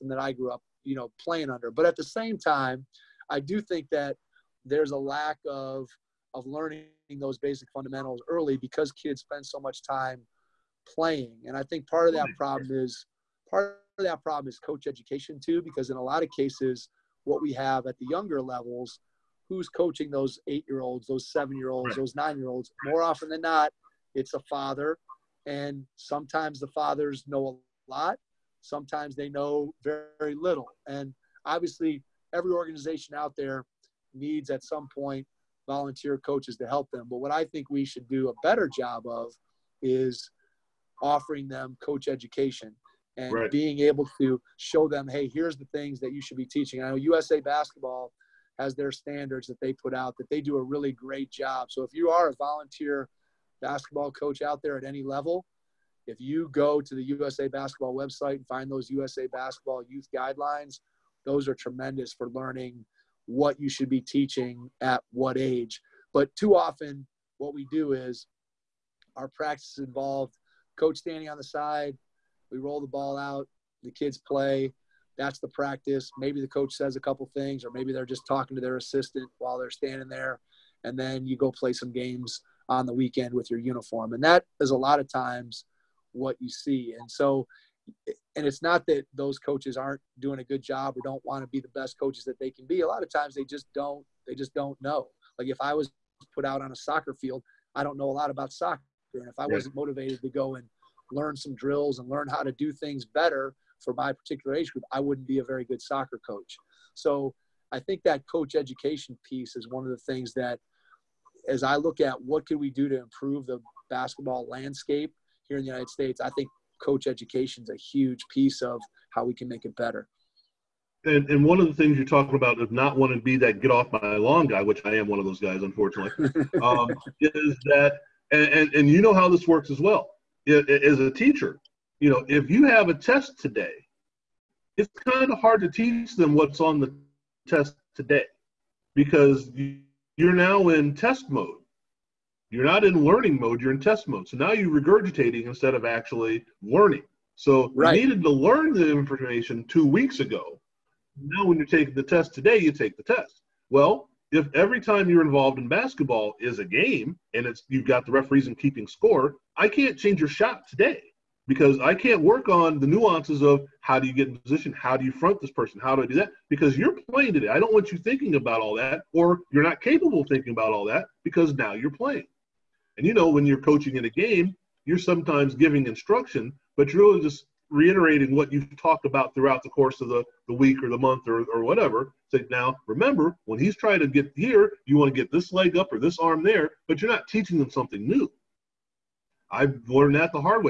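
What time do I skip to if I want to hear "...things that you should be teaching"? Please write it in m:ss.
0:45.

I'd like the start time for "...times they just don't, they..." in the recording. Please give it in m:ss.
1:33.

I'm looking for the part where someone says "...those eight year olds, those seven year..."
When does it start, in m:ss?
0:20.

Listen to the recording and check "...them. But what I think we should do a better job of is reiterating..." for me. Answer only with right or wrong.
wrong.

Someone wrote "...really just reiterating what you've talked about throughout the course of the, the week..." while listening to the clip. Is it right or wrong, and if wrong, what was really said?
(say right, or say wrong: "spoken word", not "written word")
right.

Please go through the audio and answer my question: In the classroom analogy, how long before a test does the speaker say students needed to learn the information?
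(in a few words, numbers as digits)
Two weeks.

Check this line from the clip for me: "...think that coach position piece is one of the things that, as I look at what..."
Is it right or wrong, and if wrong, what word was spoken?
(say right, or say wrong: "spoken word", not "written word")
wrong: "education", not "position".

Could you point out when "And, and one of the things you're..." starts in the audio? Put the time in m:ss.
2:01.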